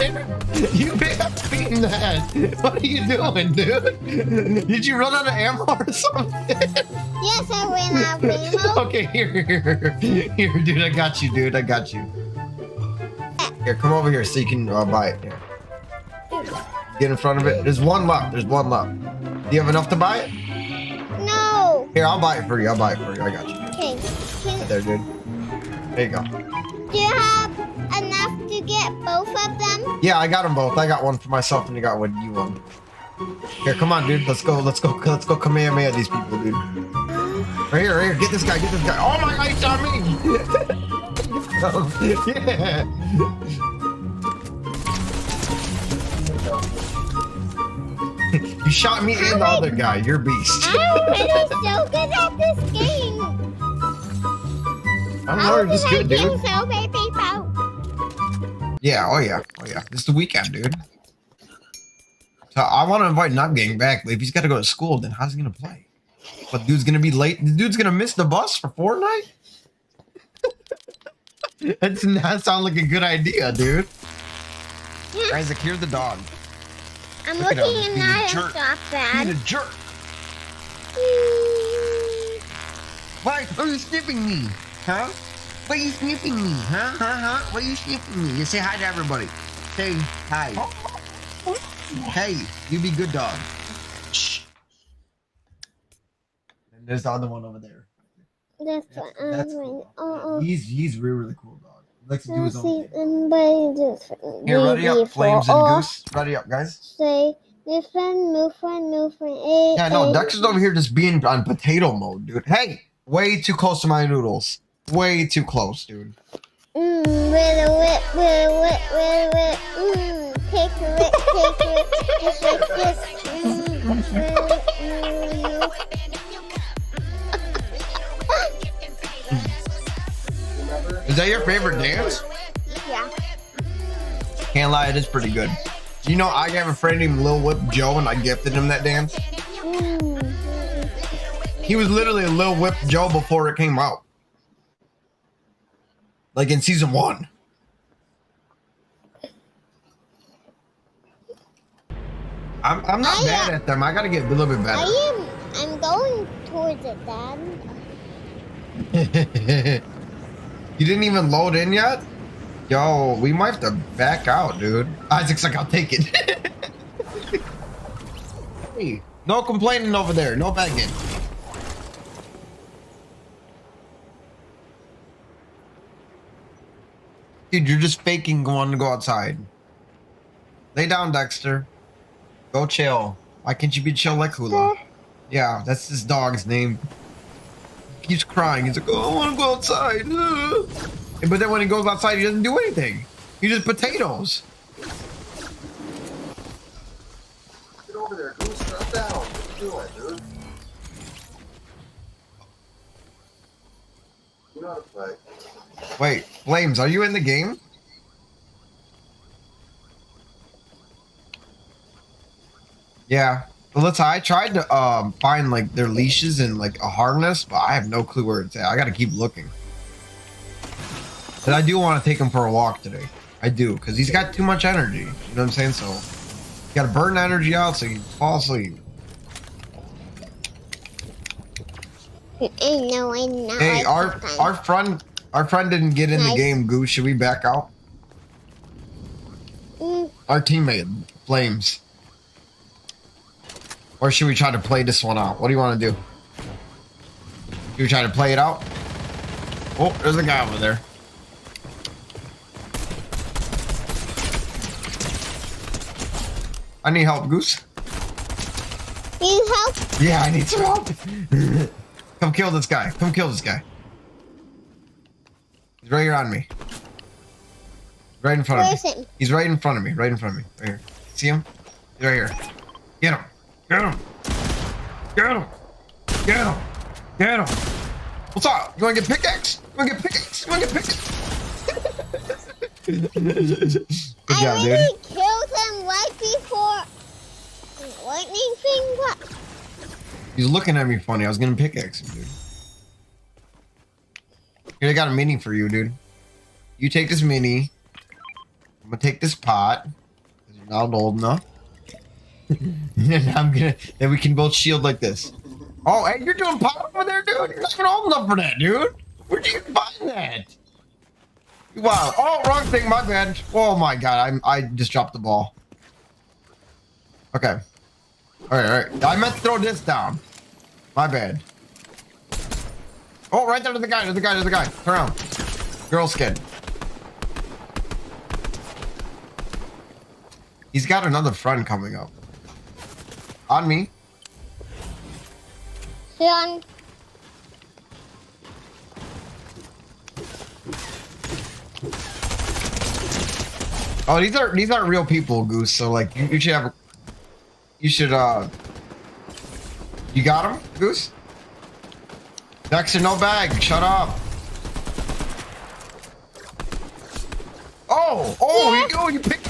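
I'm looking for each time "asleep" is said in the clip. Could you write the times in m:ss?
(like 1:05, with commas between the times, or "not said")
3:48.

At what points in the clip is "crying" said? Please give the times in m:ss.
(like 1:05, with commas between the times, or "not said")
3:08.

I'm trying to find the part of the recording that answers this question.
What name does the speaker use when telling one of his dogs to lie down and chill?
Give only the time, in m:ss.
3:01.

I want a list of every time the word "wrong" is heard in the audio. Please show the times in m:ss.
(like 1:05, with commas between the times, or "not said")
5:12.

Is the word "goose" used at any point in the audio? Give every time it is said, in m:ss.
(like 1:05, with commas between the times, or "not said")
1:45, 3:18, 3:56, 4:17, 5:45, 5:50.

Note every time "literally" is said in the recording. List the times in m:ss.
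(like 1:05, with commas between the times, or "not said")
2:21.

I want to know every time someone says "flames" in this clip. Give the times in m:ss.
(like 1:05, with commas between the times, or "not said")
1:45, 3:26, 4:01.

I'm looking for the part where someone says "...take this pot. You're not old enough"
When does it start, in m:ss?
4:58.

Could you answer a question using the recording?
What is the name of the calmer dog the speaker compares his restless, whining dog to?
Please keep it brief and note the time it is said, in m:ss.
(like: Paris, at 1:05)
Hula, at 3:04.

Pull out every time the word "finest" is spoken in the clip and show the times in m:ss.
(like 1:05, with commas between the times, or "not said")
not said.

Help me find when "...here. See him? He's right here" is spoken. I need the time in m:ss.
4:30.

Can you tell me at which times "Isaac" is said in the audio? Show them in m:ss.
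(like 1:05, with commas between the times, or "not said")
1:15, 2:45.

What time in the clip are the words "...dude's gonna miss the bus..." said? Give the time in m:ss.
1:07.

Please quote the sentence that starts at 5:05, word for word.
Oh, hey, you're doing pot over there, dude.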